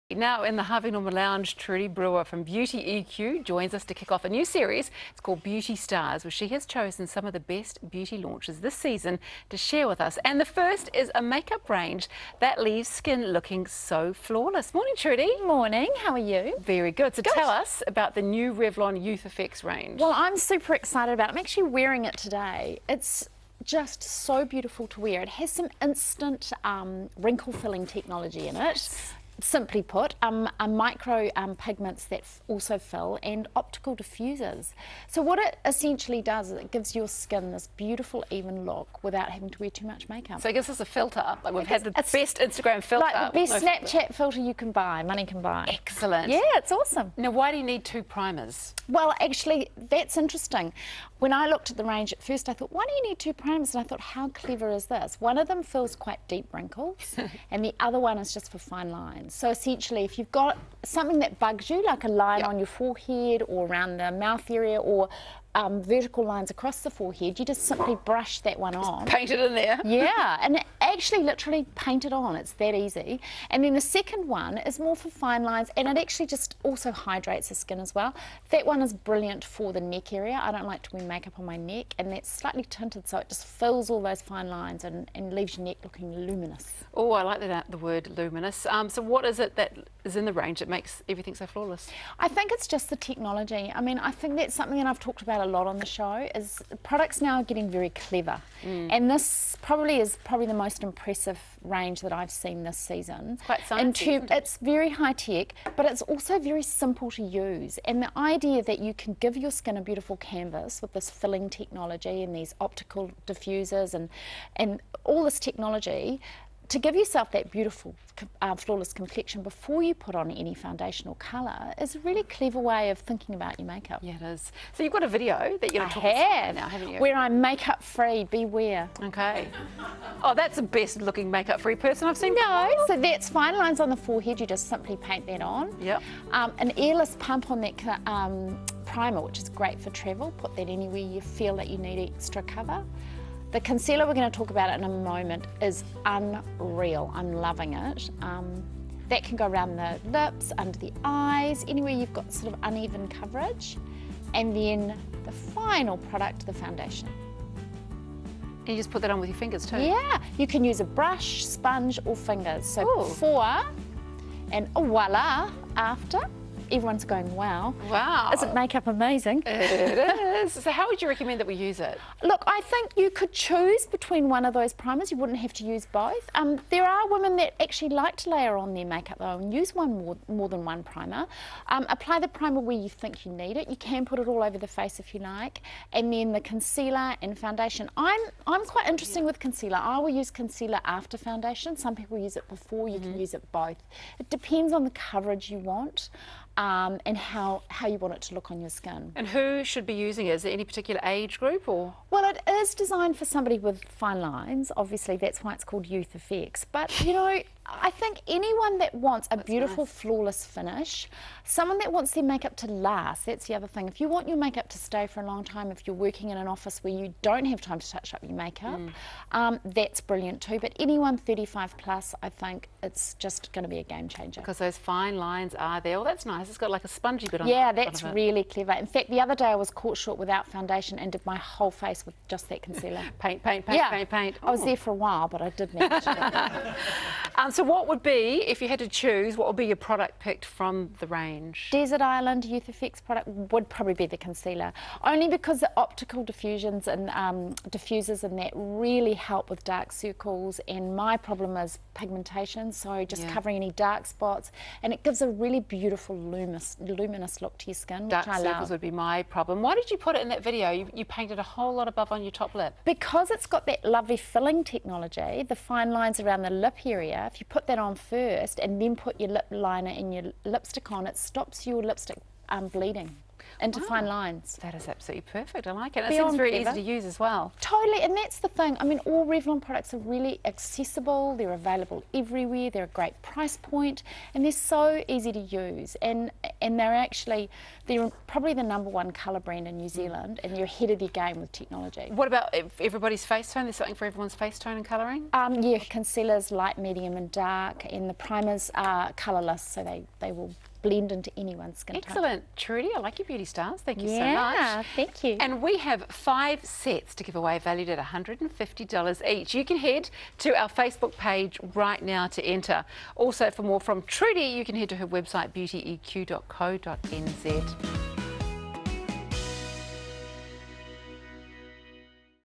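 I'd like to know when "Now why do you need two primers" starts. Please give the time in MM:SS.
00:47.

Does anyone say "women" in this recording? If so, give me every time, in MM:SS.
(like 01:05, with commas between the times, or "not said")
02:57.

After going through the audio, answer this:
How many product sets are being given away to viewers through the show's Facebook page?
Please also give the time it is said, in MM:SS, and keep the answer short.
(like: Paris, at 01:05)
5, at 05:06.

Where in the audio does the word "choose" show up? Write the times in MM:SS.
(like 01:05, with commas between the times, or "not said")
02:53, 03:58.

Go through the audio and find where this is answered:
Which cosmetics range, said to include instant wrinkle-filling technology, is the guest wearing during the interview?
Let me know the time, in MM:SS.
00:18.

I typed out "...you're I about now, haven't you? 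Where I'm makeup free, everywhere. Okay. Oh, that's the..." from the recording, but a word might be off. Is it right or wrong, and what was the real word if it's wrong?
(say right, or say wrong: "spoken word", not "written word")
wrong: "beware", not "everywhere".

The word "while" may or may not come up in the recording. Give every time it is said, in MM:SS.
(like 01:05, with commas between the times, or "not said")
03:54.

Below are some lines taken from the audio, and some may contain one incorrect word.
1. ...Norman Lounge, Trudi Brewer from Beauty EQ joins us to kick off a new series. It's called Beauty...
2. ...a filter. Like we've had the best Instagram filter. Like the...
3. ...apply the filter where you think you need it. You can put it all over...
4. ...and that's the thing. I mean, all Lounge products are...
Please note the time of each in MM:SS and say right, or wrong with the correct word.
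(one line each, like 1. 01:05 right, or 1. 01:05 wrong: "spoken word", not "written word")
1. 00:00 right
2. 00:40 right
3. 03:01 wrong: "primer", not "filter"
4. 04:38 wrong: "Revlon", not "Lounge".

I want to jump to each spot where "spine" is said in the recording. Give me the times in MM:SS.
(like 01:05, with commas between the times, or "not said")
not said.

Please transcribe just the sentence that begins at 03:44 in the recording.
Because those fine lines are there.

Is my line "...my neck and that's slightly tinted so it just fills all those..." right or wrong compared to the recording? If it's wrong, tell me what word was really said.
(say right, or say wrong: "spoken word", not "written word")
right.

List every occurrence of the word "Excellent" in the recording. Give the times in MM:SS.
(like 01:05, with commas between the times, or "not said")
00:45, 05:01.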